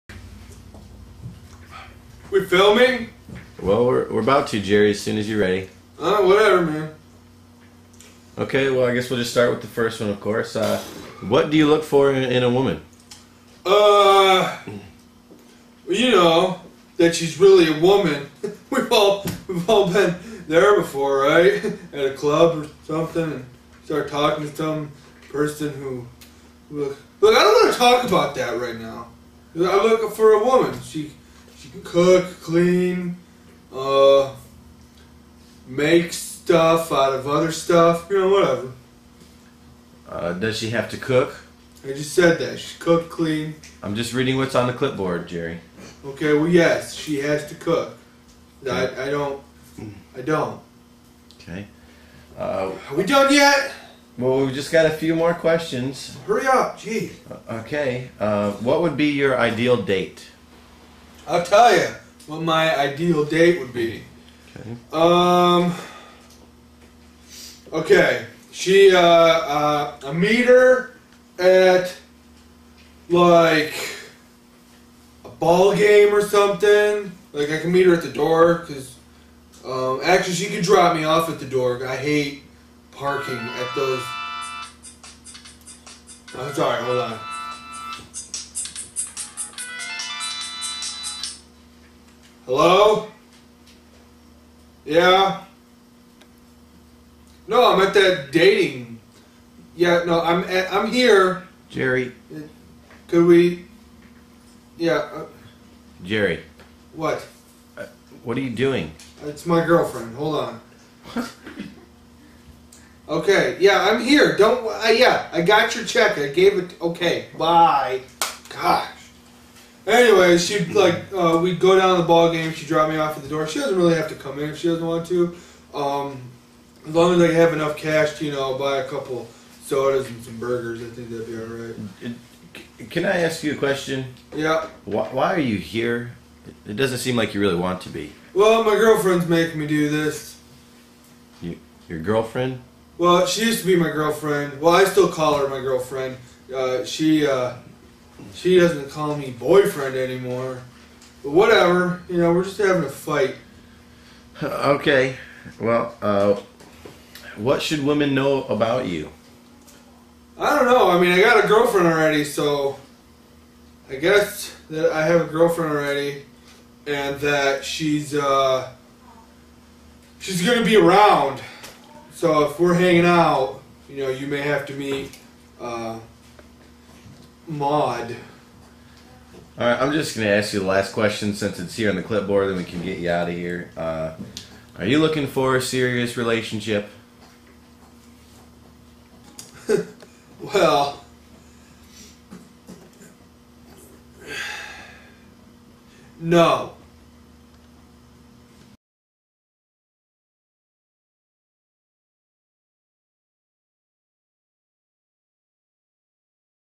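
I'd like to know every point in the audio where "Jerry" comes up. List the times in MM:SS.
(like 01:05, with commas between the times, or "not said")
00:04, 00:45, 01:41, 01:46.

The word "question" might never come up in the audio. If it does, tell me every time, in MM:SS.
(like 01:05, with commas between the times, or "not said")
00:55, 02:13, 03:00.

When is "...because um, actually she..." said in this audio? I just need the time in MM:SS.
01:18.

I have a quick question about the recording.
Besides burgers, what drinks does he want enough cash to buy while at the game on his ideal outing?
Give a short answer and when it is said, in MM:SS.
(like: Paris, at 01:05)
sodas, at 02:09.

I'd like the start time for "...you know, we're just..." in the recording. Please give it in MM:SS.
02:32.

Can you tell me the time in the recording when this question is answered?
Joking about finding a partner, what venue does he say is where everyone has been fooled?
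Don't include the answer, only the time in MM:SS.
00:21.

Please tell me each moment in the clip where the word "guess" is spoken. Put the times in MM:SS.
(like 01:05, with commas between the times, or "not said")
00:08, 02:43.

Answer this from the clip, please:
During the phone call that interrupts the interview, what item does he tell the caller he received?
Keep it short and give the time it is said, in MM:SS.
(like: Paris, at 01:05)
check, at 01:55.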